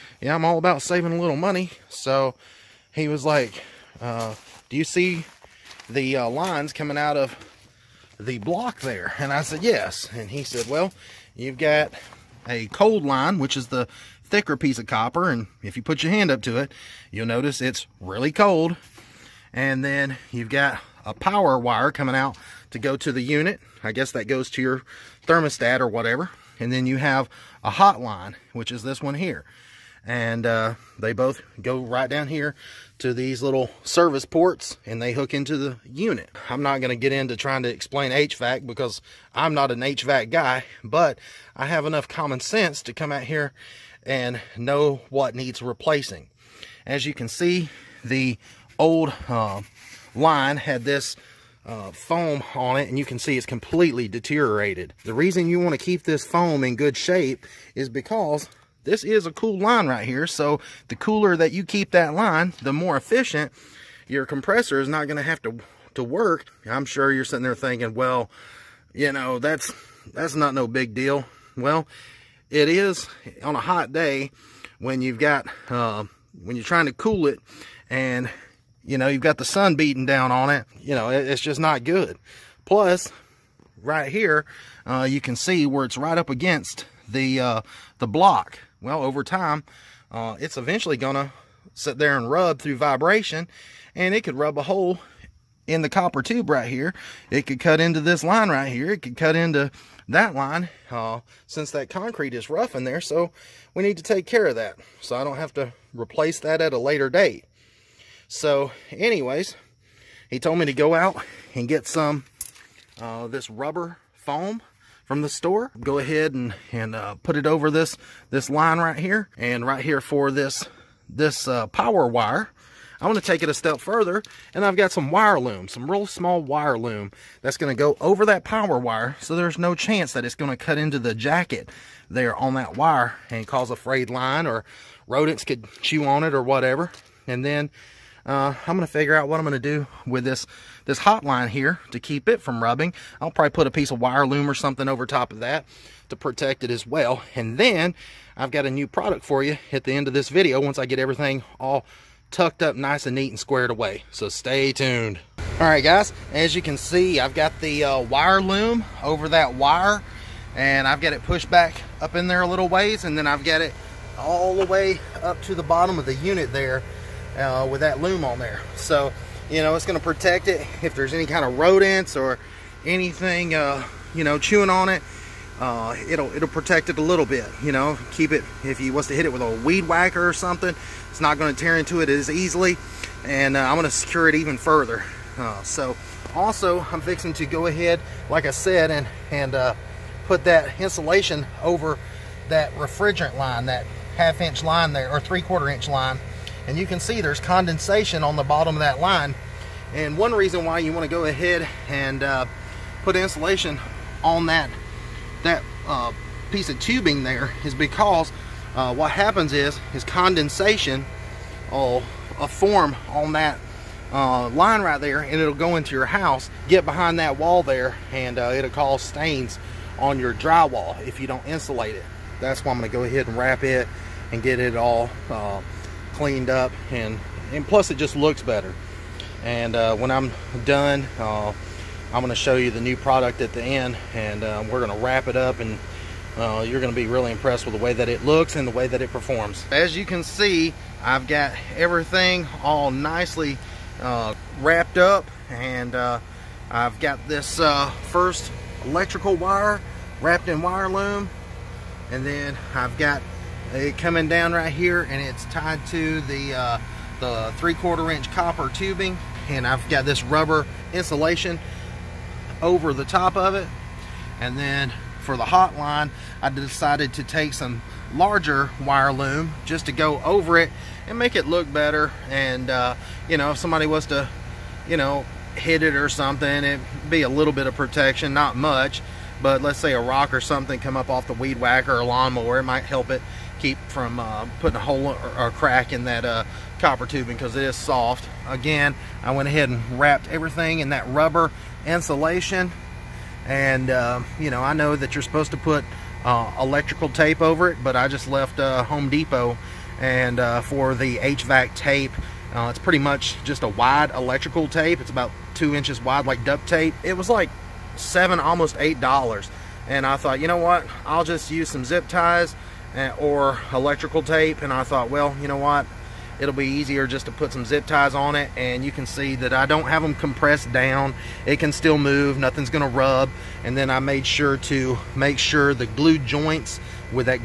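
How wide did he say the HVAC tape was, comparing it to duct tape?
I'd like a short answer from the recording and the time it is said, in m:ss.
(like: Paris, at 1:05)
2 inches, at 5:05.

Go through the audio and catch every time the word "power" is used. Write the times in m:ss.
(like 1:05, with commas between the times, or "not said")
0:21, 2:01, 2:08.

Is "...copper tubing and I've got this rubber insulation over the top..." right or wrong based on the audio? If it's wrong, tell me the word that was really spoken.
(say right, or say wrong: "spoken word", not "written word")
right.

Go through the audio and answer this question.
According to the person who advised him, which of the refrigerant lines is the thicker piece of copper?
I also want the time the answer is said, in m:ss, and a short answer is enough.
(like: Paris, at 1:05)
cold line, at 0:12.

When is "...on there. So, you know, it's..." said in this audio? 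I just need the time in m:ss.
2:48.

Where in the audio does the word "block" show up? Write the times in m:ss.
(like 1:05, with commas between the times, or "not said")
0:08, 1:28.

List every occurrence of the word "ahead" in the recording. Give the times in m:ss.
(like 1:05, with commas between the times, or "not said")
1:55, 3:07, 3:21, 3:43, 4:49.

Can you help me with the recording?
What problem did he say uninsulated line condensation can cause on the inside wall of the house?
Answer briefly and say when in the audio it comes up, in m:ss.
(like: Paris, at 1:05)
stains on your drywall, at 3:39.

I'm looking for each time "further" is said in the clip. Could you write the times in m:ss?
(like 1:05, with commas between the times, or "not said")
2:03, 3:04.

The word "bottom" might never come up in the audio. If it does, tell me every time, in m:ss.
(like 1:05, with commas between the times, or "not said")
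2:45, 3:18.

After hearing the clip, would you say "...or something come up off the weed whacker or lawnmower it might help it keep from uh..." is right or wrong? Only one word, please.
right.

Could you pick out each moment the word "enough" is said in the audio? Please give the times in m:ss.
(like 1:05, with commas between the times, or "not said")
0:41.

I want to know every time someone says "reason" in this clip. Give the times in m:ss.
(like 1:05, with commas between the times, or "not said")
0:55, 3:20.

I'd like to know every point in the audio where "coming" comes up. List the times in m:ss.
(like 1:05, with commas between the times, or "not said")
0:06, 0:21, 4:13.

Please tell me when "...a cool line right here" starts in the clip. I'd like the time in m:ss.
0:59.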